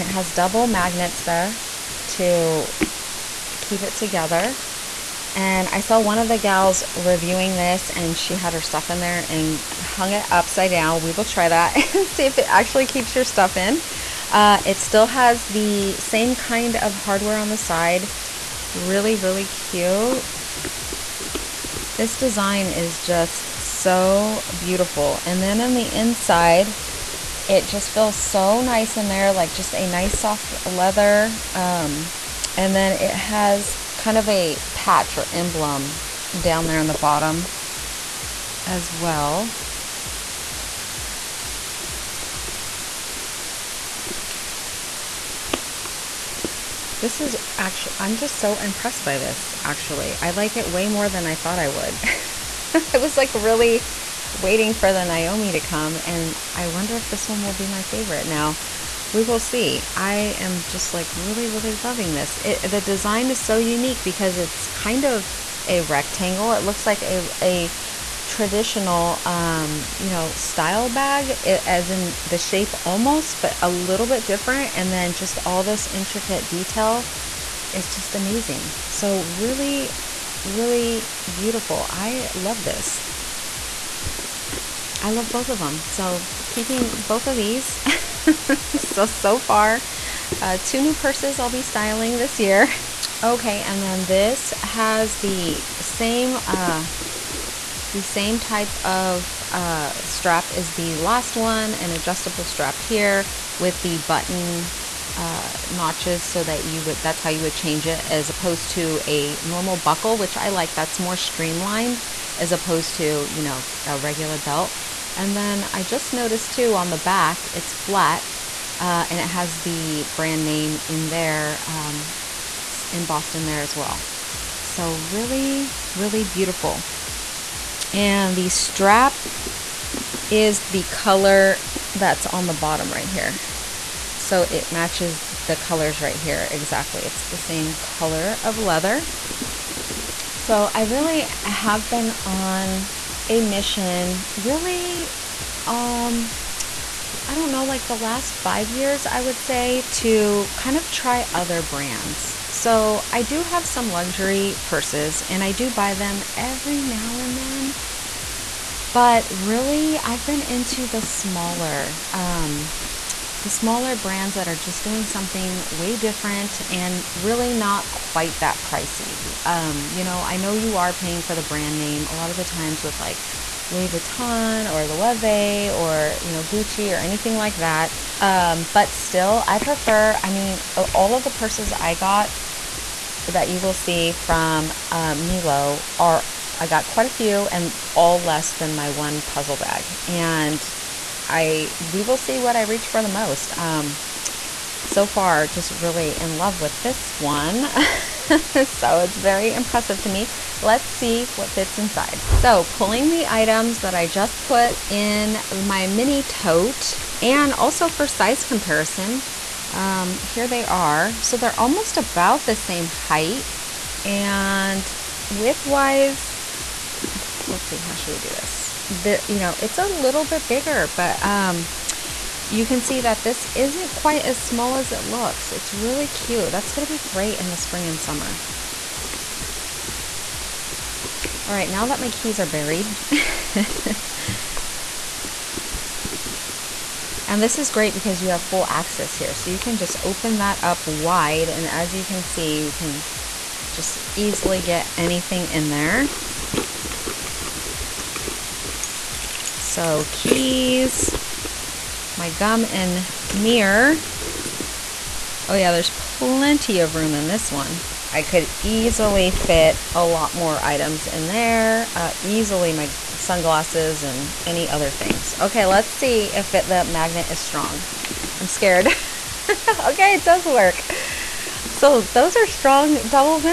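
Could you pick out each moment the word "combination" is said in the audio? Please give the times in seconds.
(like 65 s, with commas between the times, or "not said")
not said.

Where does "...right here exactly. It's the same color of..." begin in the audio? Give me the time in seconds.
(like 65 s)
136 s.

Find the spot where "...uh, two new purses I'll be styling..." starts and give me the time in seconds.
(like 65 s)
90 s.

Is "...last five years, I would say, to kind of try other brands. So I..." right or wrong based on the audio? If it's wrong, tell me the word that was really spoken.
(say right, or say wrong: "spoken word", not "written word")
right.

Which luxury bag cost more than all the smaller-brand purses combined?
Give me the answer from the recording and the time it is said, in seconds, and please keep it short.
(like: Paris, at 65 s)
puzzle bag, at 189 s.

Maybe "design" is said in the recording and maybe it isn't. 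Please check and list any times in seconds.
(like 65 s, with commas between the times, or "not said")
22 s, 62 s.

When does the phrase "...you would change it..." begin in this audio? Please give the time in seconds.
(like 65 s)
107 s.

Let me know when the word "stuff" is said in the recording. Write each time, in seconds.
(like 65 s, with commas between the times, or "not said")
8 s, 13 s.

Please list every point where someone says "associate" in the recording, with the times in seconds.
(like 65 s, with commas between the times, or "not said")
not said.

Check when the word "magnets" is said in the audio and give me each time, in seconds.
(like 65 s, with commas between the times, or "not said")
0 s, 266 s.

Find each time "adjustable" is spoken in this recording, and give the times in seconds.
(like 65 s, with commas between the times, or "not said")
101 s.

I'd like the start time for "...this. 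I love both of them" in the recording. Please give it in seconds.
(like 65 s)
82 s.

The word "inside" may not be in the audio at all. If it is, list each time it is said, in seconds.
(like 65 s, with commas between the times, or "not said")
25 s, 201 s.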